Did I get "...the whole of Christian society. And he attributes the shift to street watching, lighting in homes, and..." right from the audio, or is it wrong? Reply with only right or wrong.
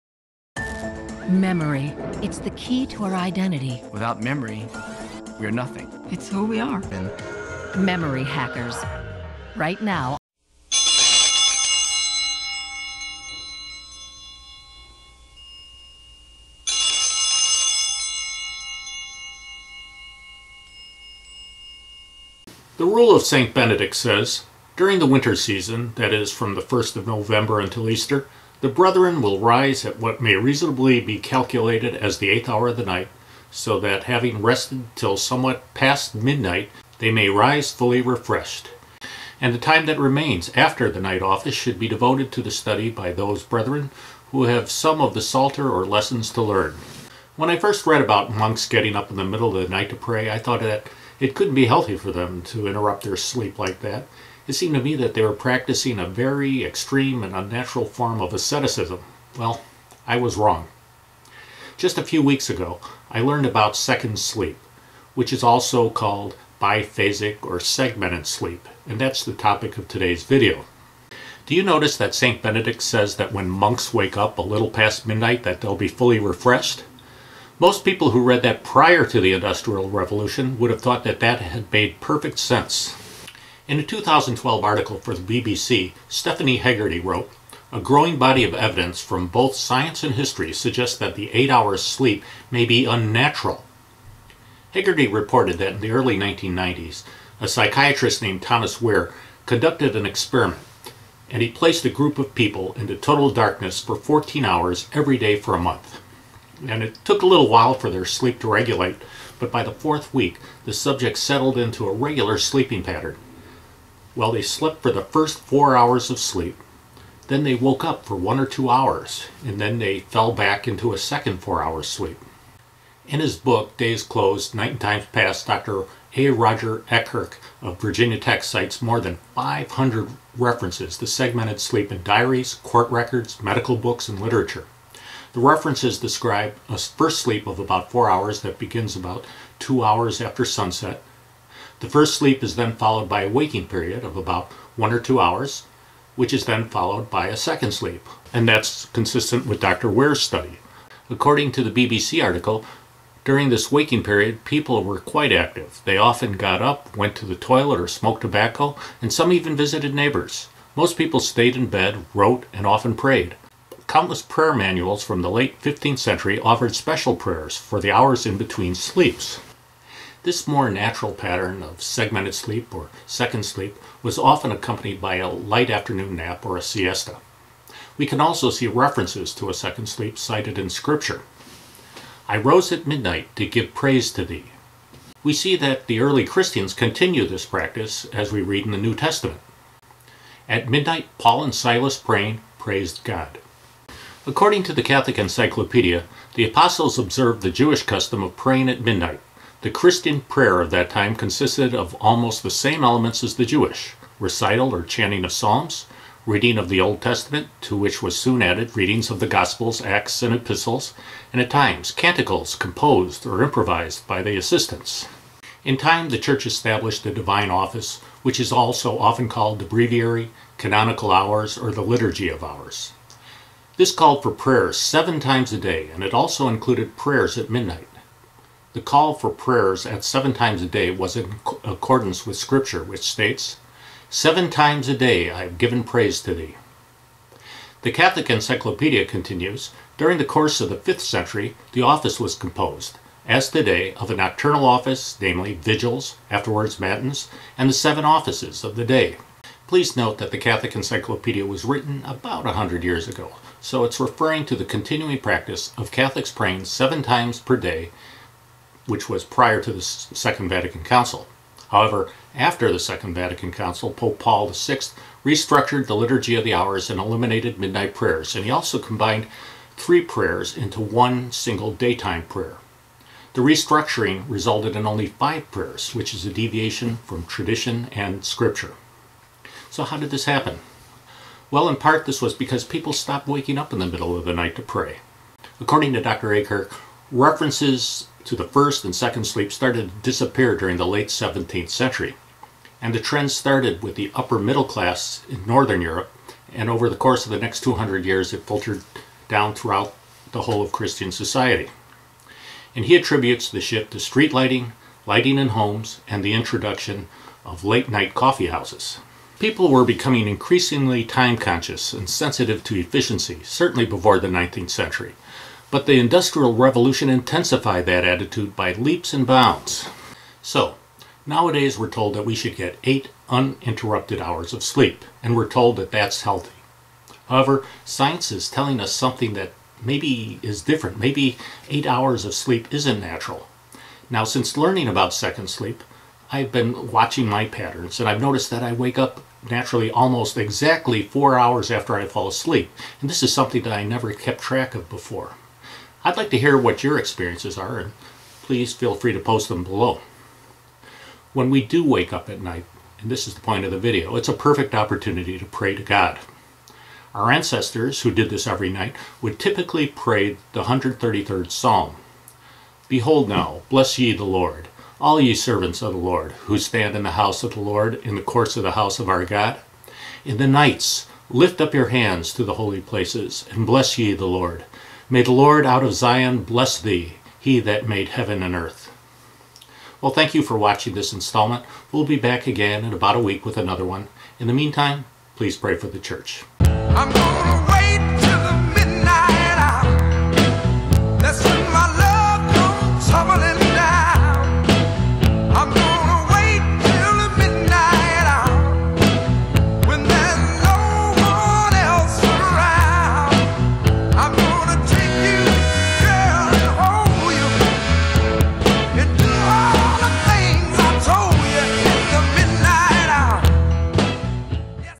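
wrong.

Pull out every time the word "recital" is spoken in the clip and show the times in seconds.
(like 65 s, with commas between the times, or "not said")
204 s.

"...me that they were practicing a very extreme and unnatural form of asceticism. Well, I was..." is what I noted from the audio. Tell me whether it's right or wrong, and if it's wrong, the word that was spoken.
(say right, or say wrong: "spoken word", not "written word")
right.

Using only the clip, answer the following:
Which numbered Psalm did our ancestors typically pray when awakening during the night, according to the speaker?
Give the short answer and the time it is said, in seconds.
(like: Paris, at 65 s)
133rd Psalm, at 360 s.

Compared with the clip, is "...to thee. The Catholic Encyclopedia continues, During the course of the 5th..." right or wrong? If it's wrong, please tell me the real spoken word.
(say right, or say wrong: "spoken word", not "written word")
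right.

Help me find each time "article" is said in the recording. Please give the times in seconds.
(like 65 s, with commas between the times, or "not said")
84 s, 152 s.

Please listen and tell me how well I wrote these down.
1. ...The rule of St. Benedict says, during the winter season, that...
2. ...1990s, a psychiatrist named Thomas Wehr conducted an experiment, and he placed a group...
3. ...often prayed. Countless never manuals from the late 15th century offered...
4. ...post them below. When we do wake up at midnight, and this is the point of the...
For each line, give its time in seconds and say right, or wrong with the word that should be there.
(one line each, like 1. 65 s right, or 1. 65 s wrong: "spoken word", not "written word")
1. 22 s right
2. 96 s right
3. 162 s wrong: "prayer", not "never"
4. 349 s wrong: "night", not "midnight".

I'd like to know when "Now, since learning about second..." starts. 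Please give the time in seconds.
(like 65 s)
334 s.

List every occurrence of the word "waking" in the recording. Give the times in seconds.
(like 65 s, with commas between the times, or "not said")
143 s, 153 s, 283 s.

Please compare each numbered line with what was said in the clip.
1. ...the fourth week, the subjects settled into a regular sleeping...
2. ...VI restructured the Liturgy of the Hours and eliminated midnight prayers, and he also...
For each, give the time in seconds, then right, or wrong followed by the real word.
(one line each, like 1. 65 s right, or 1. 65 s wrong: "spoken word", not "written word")
1. 109 s right
2. 264 s right.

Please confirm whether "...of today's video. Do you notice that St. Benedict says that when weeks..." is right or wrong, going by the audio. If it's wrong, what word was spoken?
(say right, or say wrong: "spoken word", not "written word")
wrong: "monks", not "weeks".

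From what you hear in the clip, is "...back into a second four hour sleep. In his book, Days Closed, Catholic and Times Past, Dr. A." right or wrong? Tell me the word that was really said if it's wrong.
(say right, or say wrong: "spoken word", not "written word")
wrong: "Night", not "Catholic".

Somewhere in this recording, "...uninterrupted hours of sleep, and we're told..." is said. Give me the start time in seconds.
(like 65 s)
323 s.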